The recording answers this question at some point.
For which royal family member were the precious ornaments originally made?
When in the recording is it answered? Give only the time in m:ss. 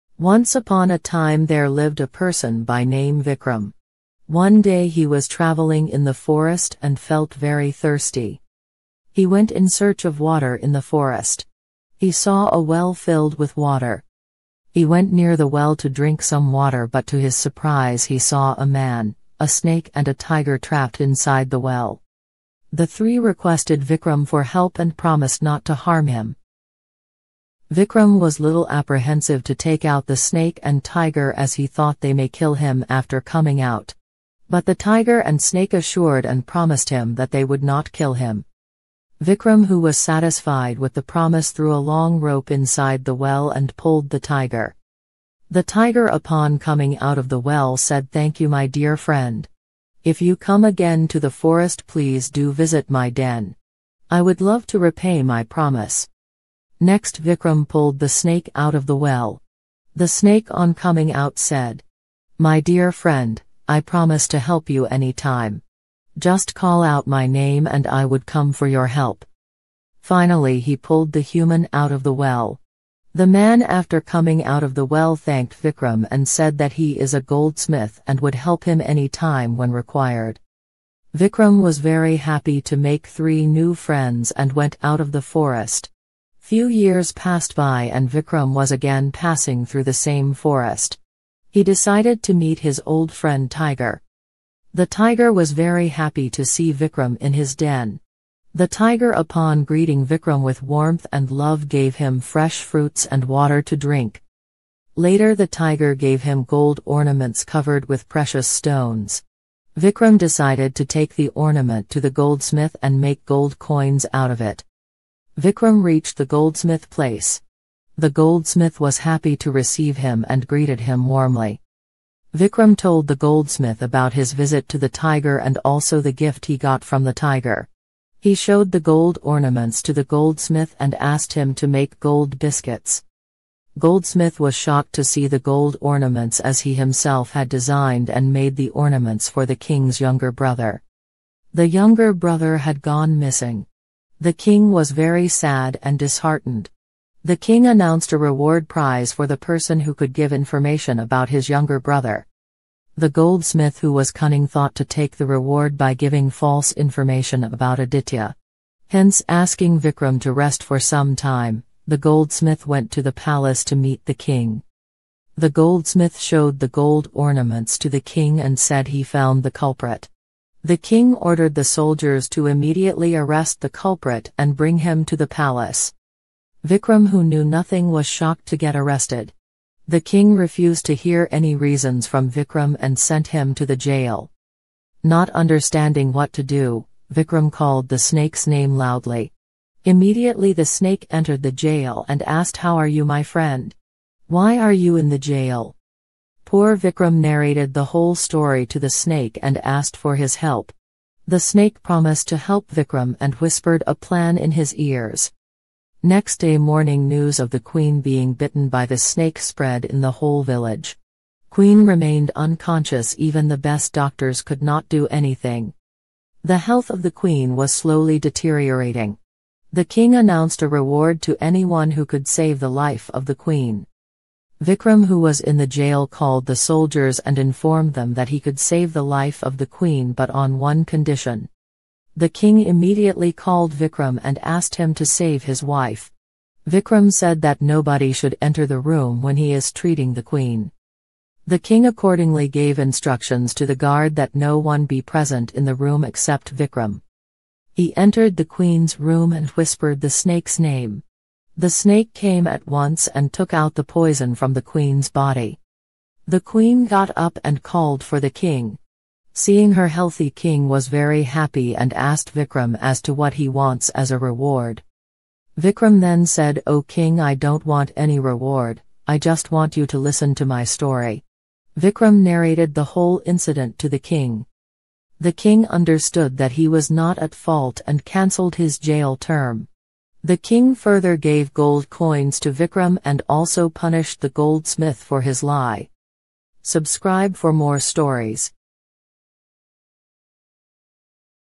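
2:19.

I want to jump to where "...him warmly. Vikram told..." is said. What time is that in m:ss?
2:00.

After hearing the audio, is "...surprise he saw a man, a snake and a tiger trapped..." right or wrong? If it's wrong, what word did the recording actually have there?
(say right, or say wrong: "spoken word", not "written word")
right.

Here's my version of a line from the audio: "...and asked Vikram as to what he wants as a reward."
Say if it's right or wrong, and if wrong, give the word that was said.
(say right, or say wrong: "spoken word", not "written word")
right.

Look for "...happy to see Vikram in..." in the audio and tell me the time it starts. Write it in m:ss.
1:35.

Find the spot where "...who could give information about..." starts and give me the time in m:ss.
2:29.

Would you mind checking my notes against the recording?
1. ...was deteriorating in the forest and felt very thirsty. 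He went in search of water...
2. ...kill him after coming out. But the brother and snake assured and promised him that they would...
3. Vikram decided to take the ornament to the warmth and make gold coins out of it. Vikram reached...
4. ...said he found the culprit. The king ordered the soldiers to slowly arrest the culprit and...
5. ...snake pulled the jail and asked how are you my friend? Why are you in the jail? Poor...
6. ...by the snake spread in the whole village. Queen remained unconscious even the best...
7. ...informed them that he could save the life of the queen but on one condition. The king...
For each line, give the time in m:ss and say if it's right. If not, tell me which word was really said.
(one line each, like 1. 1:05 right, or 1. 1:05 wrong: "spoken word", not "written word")
1. 0:05 wrong: "traveling", not "deteriorating"
2. 0:32 wrong: "tiger", not "brother"
3. 1:49 wrong: "goldsmith", not "warmth"
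4. 2:48 wrong: "immediately", not "slowly"
5. 3:10 wrong: "entered", not "pulled"
6. 3:28 right
7. 3:47 right.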